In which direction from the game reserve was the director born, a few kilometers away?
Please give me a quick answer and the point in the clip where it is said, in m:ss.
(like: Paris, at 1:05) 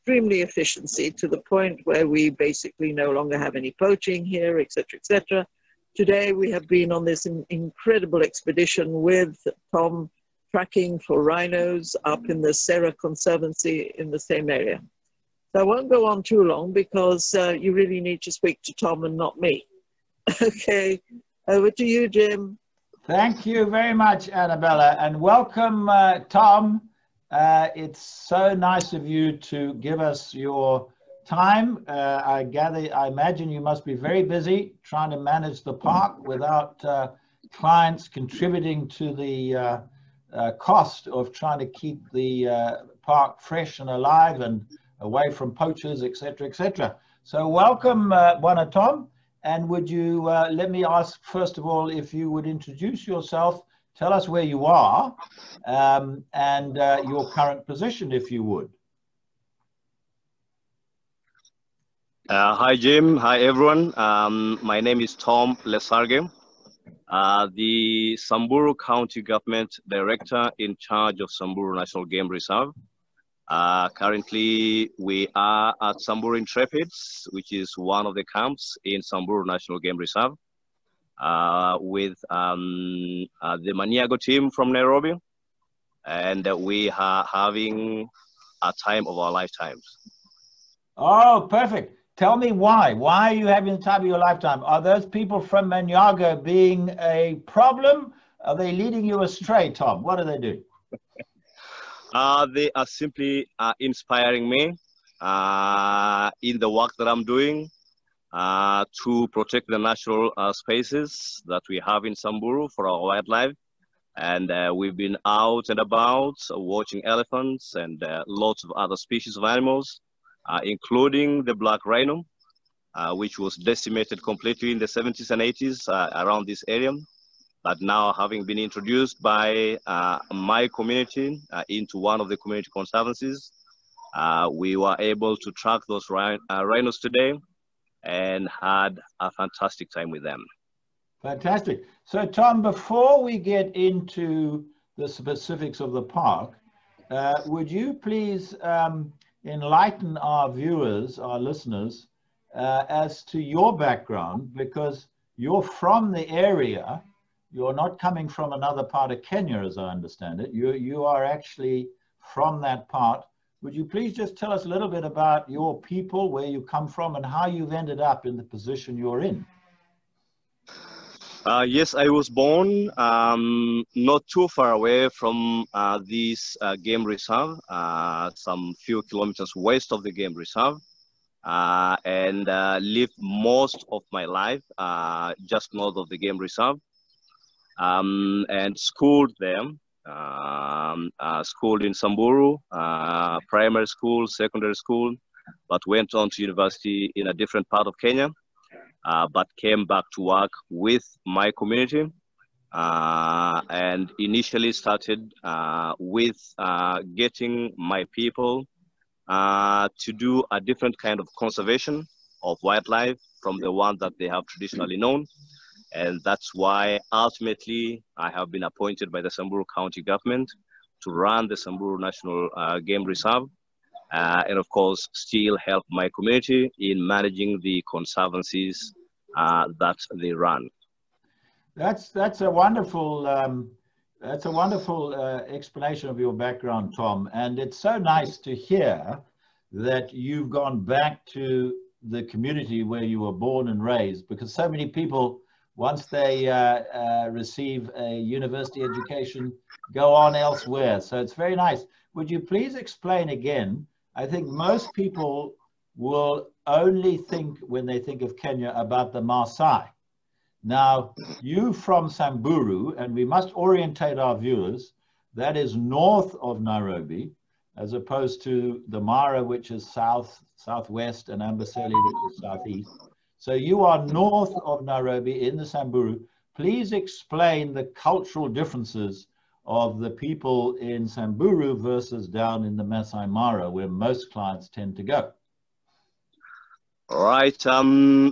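West, at 2:59.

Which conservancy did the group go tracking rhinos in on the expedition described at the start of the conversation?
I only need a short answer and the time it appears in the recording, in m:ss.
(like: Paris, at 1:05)
Sera Conservancy, at 0:12.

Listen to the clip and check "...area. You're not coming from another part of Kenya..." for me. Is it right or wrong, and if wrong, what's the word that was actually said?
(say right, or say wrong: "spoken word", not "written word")
right.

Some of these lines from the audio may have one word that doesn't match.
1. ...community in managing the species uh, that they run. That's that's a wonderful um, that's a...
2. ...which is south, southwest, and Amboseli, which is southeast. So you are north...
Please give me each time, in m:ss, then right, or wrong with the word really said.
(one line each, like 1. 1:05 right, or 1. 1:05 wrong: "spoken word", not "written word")
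1. 3:46 wrong: "conservancies", not "species"
2. 4:29 right.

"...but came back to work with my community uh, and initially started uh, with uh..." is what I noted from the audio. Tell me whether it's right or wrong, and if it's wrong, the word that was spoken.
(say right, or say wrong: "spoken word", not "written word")
right.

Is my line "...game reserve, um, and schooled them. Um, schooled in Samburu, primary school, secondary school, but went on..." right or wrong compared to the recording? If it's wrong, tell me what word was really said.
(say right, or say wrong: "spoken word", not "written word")
right.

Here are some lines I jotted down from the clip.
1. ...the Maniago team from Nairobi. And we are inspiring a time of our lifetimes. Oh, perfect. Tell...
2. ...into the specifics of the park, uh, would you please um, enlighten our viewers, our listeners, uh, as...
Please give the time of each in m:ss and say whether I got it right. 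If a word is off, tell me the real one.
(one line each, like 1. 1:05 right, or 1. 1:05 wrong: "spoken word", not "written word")
1. 1:23 wrong: "having", not "inspiring"
2. 2:23 right.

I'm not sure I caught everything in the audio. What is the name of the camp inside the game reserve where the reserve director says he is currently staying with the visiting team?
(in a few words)
Samburu Intrepids.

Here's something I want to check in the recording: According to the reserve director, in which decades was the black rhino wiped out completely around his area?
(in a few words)
The 70s and 80s.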